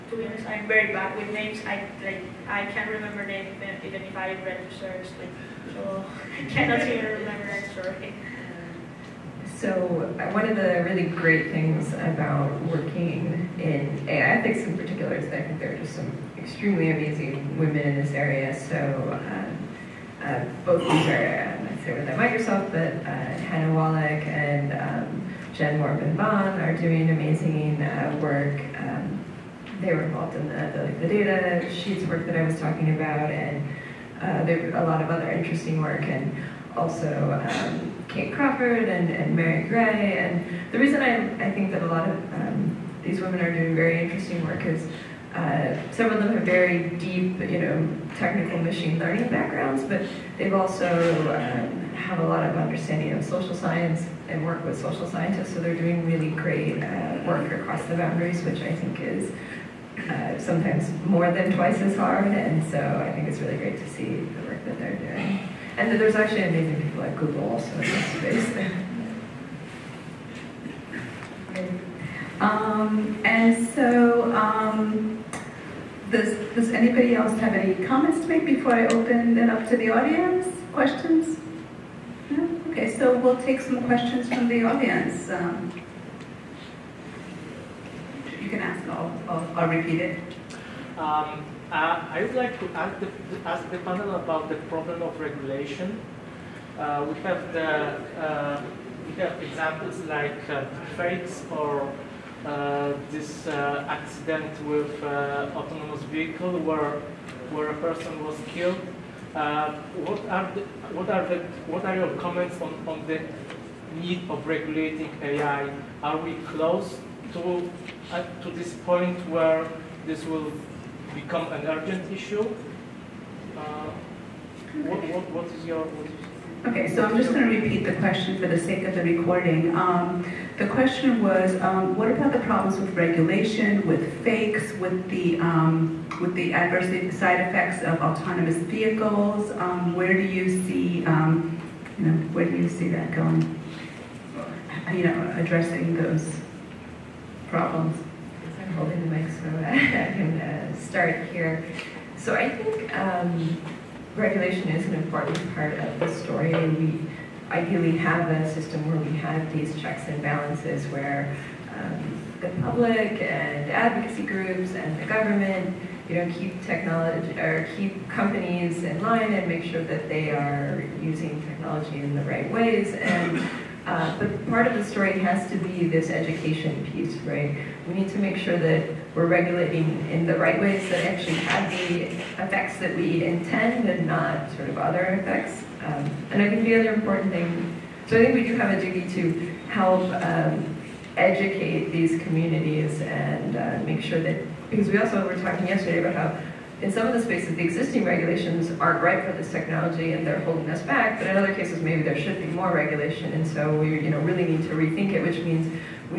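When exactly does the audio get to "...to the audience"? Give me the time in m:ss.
1:19.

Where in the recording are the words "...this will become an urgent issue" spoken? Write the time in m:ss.
2:00.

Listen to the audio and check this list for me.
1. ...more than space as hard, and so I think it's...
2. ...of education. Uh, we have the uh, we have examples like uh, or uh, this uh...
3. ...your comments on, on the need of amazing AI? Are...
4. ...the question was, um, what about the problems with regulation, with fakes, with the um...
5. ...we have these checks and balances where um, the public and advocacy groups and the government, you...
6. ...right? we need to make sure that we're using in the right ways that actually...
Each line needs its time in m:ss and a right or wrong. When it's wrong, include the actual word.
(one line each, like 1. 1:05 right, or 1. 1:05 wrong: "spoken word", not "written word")
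1. 1:01 wrong: "twice", not "space"
2. 1:35 wrong: "regulation", not "education"
3. 1:51 wrong: "regulating", not "amazing"
4. 2:10 right
5. 2:38 right
6. 2:57 wrong: "regulating", not "using".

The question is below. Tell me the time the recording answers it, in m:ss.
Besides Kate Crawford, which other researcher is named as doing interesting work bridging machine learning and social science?
0:39.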